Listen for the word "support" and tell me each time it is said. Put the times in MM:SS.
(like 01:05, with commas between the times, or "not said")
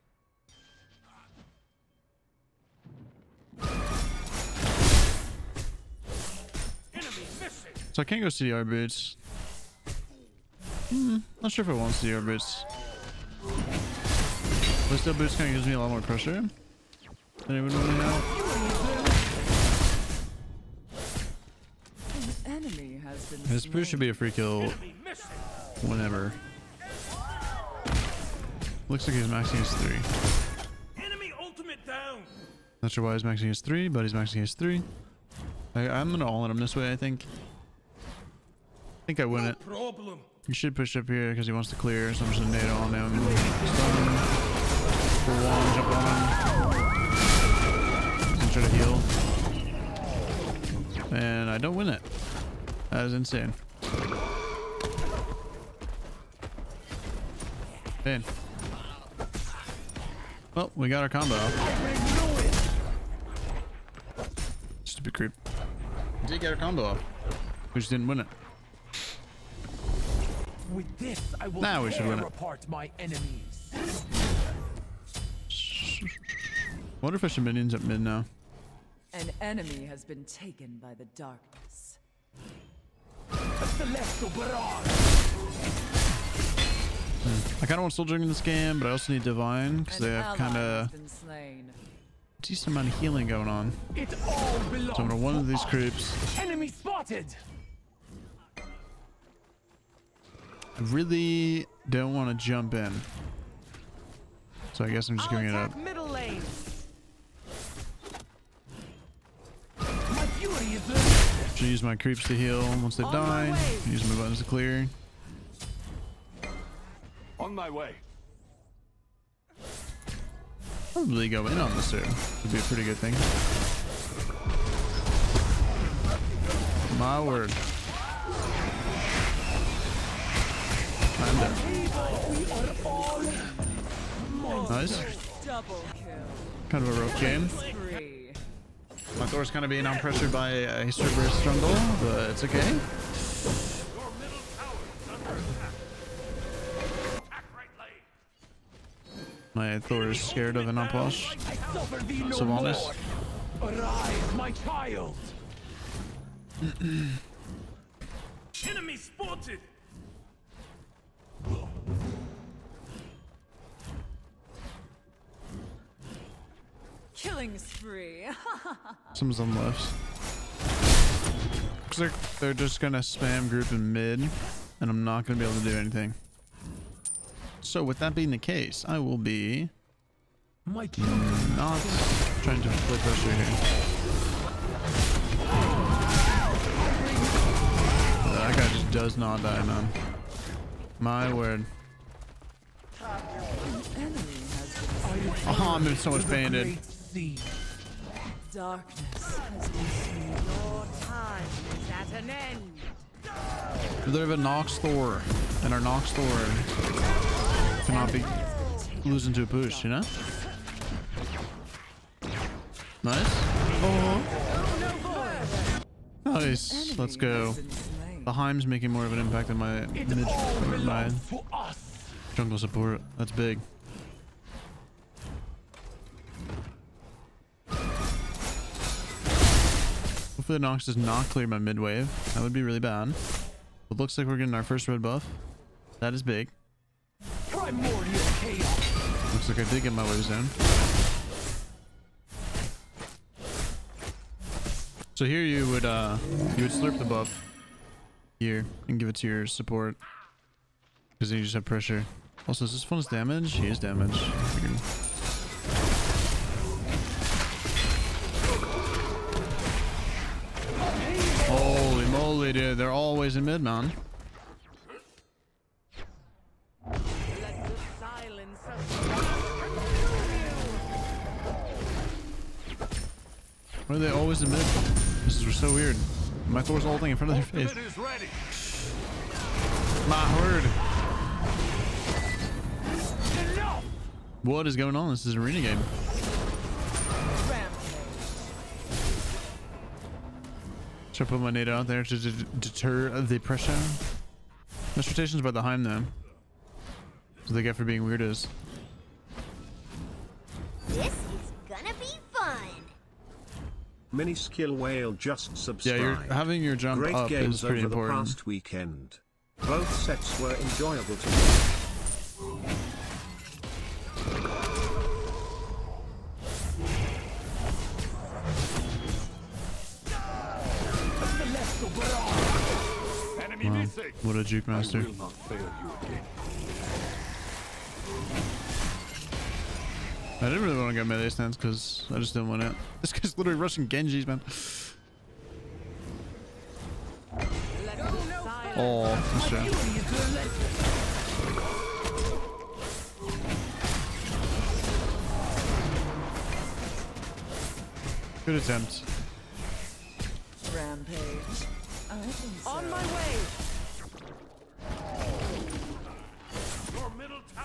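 03:42, 04:09.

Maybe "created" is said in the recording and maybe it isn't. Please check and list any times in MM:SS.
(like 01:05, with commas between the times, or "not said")
not said.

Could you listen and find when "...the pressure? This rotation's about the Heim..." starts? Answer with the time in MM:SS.
04:53.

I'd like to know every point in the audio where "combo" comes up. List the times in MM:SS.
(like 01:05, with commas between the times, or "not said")
01:01, 01:06.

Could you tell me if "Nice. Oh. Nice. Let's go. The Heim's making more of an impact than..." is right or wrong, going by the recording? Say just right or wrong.
right.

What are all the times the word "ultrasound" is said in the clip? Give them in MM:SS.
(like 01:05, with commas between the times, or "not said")
not said.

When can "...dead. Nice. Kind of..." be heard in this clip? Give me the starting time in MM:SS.
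02:14.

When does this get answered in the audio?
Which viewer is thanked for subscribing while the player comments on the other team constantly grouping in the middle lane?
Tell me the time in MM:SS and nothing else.
05:04.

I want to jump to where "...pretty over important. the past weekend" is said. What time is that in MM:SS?
05:07.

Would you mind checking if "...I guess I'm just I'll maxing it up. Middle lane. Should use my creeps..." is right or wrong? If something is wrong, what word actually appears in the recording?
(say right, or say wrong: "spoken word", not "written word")
wrong: "giving", not "maxing".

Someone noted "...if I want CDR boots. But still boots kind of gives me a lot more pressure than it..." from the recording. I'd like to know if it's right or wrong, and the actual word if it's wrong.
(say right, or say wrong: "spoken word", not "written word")
right.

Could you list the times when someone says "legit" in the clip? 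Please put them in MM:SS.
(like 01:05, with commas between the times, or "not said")
not said.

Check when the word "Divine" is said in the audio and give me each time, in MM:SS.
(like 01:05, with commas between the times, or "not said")
01:29.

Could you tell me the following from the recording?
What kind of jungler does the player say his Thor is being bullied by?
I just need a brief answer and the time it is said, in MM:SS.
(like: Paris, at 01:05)
History Burst jungle, at 02:20.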